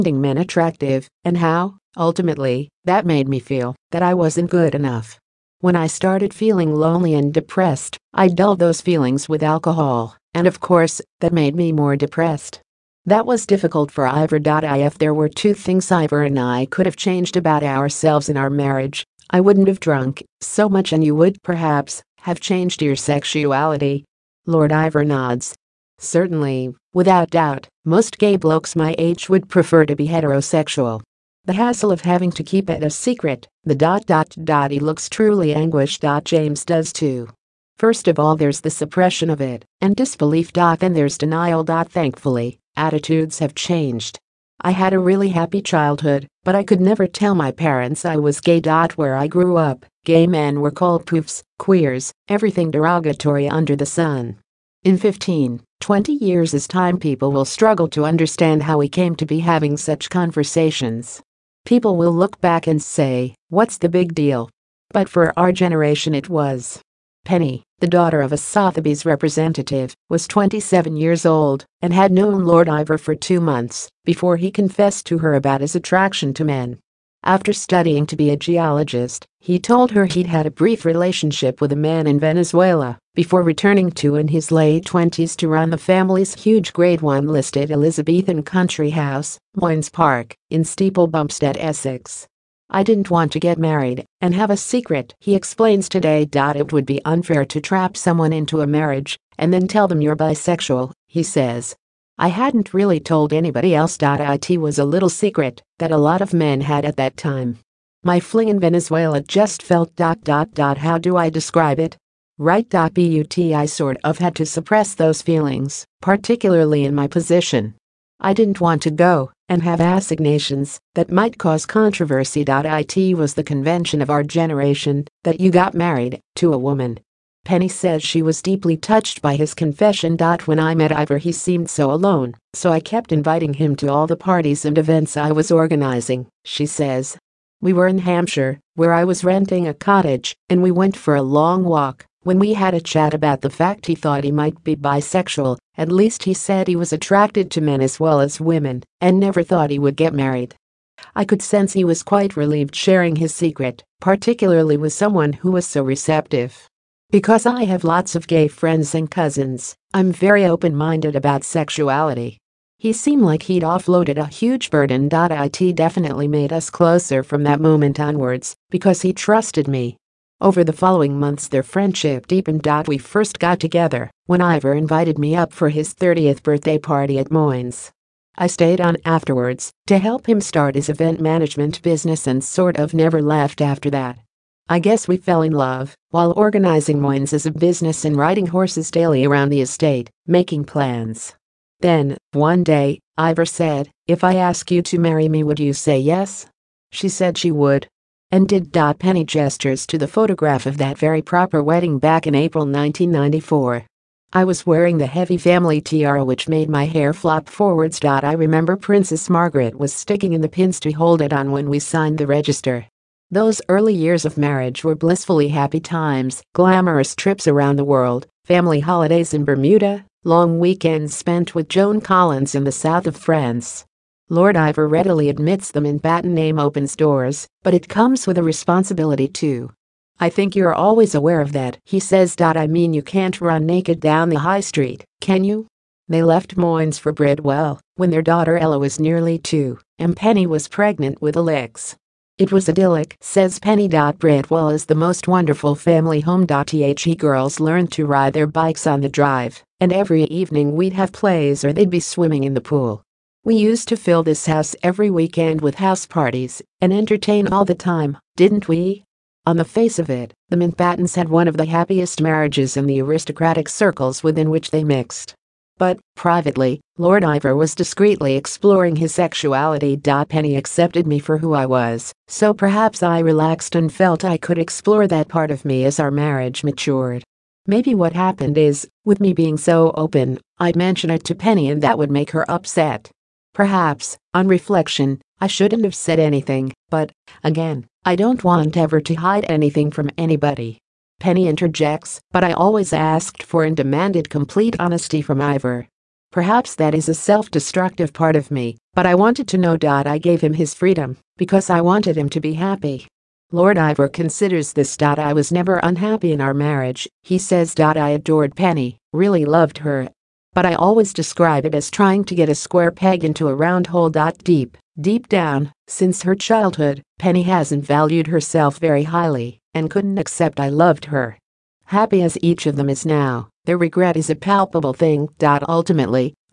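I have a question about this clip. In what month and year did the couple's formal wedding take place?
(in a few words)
April 1994.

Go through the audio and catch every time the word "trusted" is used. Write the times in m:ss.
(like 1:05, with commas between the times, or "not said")
2:49.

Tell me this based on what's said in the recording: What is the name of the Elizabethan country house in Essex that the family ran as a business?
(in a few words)
Moyns Park.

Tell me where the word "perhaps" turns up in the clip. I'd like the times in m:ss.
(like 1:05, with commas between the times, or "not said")
0:21, 4:32, 4:43, 4:56.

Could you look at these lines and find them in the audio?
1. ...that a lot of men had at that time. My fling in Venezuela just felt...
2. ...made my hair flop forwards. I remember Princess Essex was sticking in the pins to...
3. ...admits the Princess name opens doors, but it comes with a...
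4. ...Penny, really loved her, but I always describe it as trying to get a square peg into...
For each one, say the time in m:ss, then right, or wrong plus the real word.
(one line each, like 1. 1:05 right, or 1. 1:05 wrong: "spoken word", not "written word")
1. 1:45 right
2. 3:26 wrong: "Margaret", not "Essex"
3. 3:45 wrong: "Mountbatten", not "Princess"
4. 5:08 right.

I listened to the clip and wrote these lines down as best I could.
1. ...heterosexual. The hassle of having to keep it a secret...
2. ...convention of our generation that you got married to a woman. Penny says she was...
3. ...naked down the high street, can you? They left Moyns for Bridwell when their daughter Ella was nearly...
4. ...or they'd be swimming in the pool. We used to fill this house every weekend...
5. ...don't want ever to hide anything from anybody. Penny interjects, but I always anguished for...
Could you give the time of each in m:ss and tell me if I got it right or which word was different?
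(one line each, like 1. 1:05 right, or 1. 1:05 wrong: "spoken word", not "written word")
1. 0:30 right
2. 2:03 right
3. 3:53 right
4. 4:11 right
5. 4:48 wrong: "asked", not "anguished".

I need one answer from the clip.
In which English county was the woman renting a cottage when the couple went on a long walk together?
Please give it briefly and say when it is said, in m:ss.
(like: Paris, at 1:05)
Hampshire, at 2:17.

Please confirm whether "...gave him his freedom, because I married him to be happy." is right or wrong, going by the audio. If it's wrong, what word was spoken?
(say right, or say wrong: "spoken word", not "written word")
wrong: "wanted", not "married".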